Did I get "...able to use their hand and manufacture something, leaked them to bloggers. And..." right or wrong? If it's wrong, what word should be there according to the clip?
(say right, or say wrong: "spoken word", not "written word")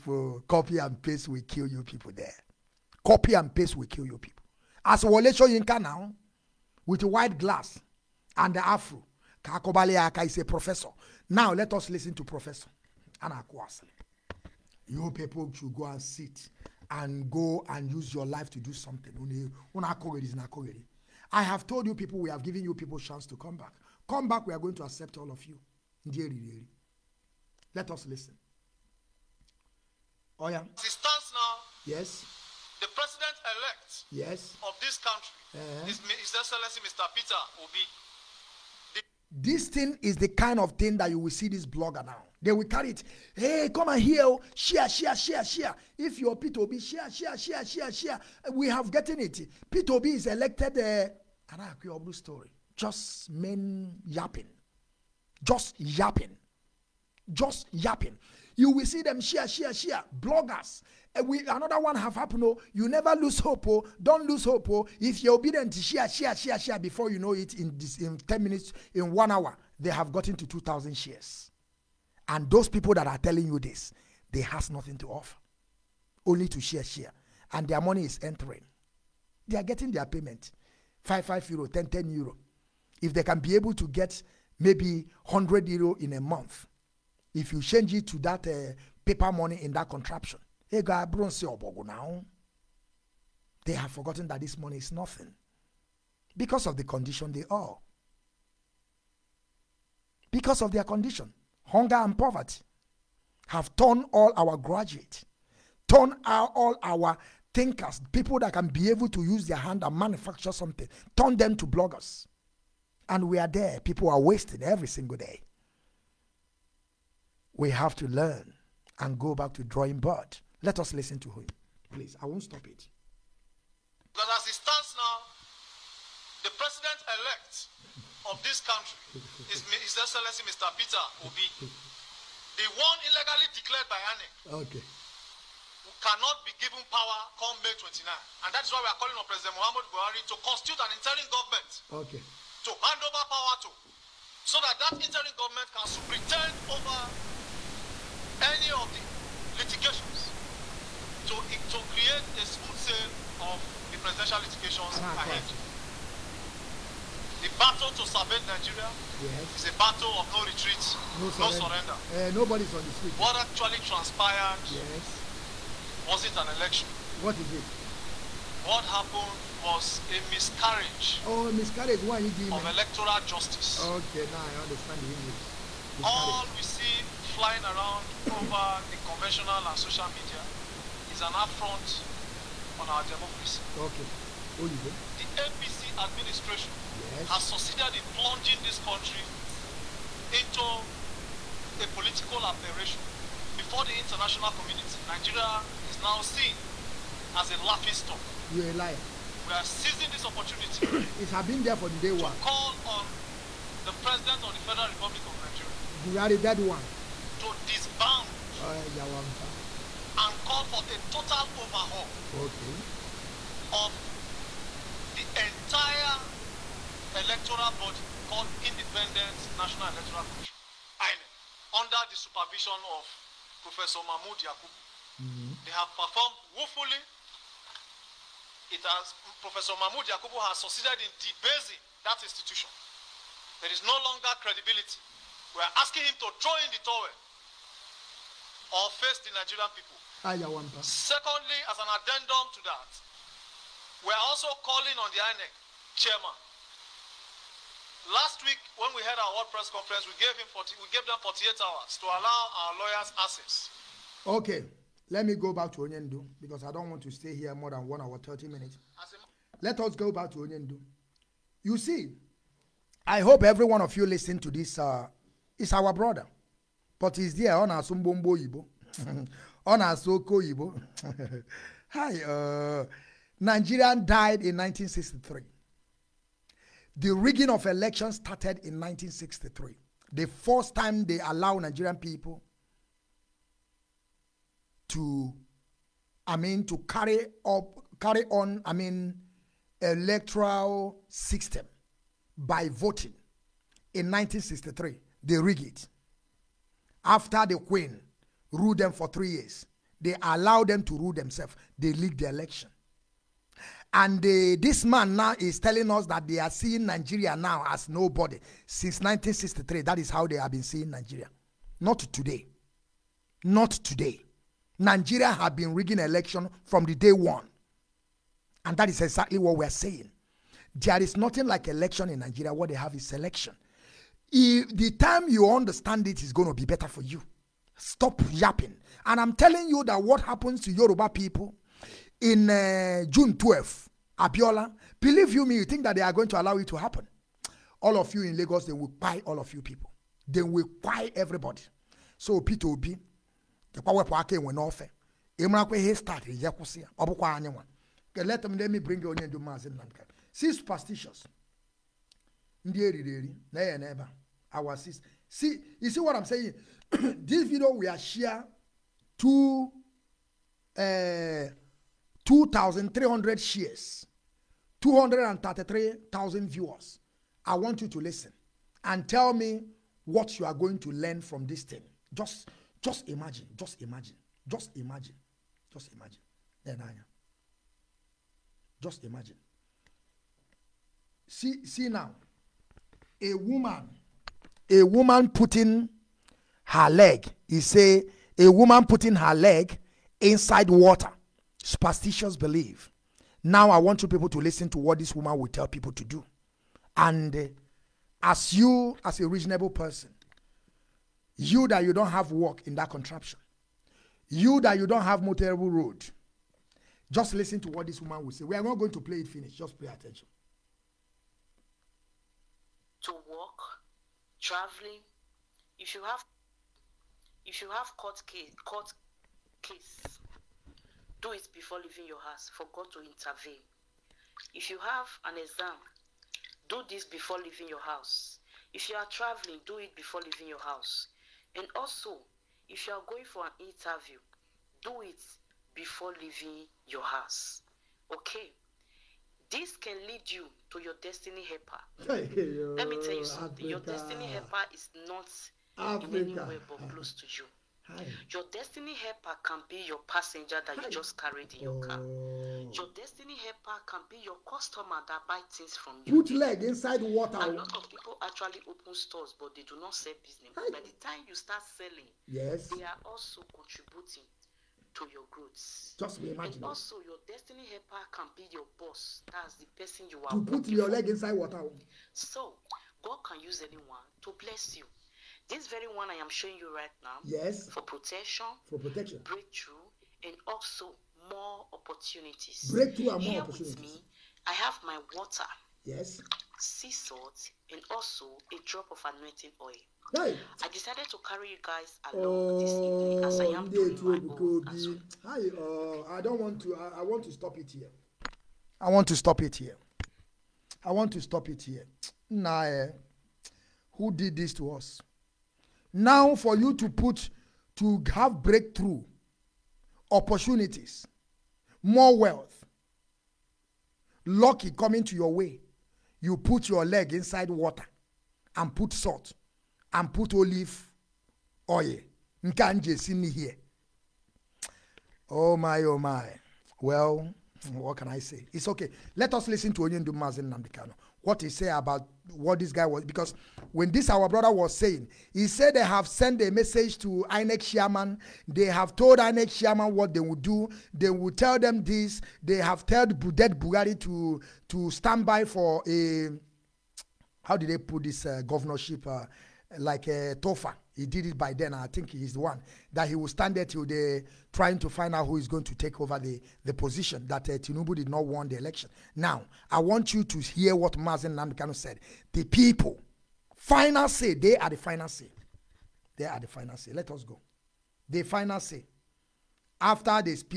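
wrong: "turned", not "leaked".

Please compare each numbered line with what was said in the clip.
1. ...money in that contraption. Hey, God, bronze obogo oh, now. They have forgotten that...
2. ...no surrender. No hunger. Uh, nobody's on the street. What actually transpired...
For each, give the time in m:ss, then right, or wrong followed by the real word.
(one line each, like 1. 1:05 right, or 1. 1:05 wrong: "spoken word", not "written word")
1. 1:29 right
2. 2:41 wrong: "surrender", not "hunger".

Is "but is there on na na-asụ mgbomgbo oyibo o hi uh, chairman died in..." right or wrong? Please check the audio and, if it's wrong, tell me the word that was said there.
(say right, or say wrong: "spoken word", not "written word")
wrong: "nigerian", not "chairman".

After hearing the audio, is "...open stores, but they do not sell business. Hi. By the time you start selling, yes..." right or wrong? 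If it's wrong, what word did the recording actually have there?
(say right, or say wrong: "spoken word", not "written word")
right.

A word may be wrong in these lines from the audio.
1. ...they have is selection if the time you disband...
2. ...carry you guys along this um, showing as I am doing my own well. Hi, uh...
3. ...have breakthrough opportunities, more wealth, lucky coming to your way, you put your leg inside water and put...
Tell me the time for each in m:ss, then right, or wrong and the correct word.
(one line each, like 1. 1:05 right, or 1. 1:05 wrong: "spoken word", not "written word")
1. 5:22 wrong: "understand", not "disband"
2. 8:11 wrong: "evening", not "showing"
3. 8:28 right.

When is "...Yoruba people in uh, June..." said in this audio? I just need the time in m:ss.
5:30.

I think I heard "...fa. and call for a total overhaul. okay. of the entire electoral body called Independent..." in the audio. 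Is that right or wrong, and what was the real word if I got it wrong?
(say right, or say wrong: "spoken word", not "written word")
right.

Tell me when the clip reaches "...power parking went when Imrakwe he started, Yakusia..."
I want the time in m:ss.
5:43.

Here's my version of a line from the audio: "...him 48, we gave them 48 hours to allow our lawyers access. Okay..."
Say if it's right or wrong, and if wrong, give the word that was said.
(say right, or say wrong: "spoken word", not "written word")
wrong: "40", not "48".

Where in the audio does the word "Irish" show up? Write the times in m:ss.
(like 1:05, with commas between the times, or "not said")
not said.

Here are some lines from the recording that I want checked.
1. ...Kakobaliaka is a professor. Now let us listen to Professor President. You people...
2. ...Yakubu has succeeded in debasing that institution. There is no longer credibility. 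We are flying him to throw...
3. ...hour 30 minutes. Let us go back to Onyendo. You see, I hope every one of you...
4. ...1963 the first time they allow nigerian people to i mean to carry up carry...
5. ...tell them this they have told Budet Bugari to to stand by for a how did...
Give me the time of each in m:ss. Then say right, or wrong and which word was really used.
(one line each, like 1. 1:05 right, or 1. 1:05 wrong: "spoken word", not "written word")
1. 0:09 wrong: "Anakwasle", not "President"
2. 3:50 wrong: "asking", not "flying"
3. 4:17 right
4. 4:38 right
5. 9:01 right.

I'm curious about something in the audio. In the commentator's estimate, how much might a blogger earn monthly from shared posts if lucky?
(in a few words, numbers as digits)
100 euro.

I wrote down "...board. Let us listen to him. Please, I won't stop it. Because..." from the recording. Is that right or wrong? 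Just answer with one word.
right.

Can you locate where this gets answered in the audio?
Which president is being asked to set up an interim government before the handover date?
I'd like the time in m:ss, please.
2:19.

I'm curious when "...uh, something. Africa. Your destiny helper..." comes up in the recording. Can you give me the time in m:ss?
7:23.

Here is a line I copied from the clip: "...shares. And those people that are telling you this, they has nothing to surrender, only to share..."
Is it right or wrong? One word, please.
wrong.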